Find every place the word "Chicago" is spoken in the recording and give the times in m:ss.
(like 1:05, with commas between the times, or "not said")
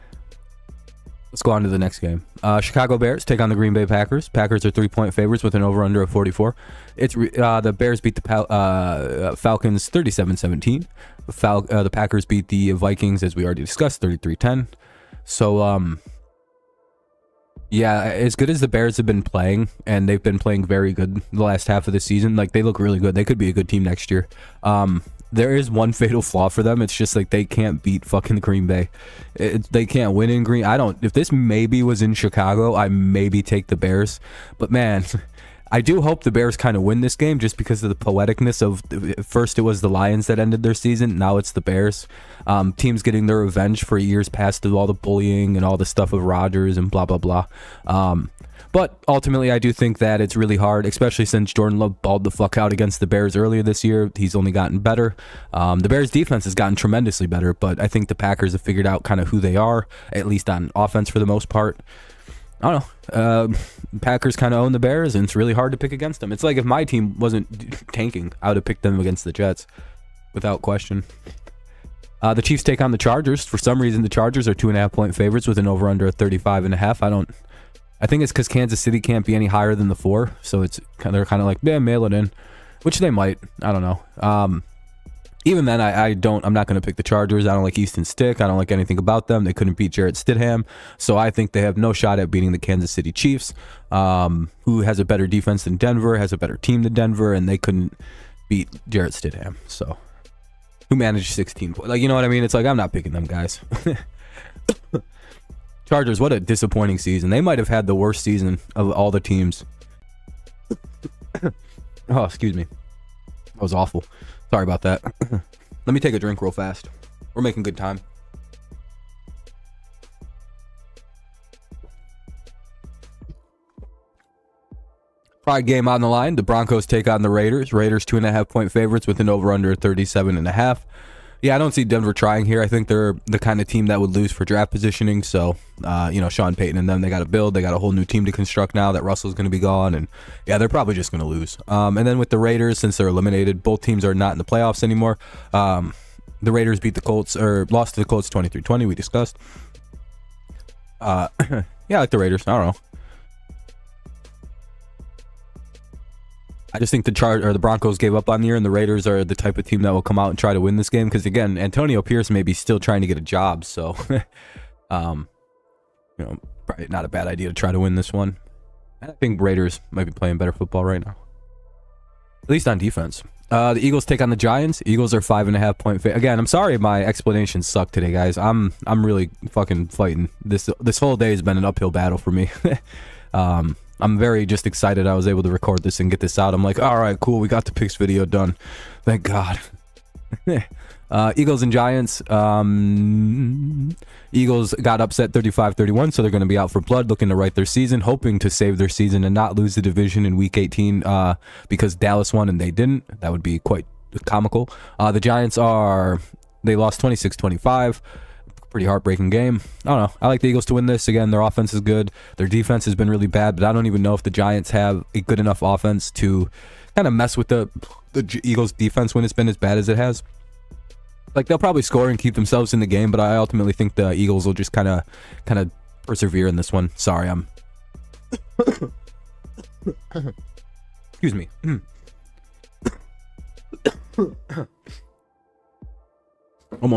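0:02, 0:32.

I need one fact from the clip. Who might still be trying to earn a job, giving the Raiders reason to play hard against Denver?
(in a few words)
Antonio Pierce.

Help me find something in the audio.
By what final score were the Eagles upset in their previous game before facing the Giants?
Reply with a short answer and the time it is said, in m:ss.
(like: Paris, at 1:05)
35-31, at 3:15.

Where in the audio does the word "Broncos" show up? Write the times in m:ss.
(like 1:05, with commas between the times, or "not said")
2:06, 2:37.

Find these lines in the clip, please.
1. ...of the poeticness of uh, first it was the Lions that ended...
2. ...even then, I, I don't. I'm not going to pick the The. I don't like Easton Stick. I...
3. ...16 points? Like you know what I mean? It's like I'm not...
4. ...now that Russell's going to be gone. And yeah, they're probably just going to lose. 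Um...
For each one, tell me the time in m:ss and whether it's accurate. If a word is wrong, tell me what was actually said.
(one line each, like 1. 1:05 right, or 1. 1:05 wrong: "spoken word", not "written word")
1. 0:37 right
2. 1:25 wrong: "Chargers", not "The"
3. 1:41 right
4. 2:18 right.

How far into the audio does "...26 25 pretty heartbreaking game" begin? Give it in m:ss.
3:26.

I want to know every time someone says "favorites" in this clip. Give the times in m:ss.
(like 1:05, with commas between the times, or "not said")
0:05, 1:15, 2:08.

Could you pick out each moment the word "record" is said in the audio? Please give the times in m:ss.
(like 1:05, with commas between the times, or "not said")
3:05.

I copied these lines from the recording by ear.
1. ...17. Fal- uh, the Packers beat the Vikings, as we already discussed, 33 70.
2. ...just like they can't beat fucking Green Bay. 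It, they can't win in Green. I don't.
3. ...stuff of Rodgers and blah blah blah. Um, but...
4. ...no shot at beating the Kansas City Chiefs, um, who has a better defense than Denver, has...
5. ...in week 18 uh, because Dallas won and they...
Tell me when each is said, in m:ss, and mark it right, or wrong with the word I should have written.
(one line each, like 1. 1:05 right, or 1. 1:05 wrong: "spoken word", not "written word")
1. 0:10 wrong: "10", not "70"
2. 0:26 right
3. 0:45 right
4. 1:31 right
5. 3:20 right.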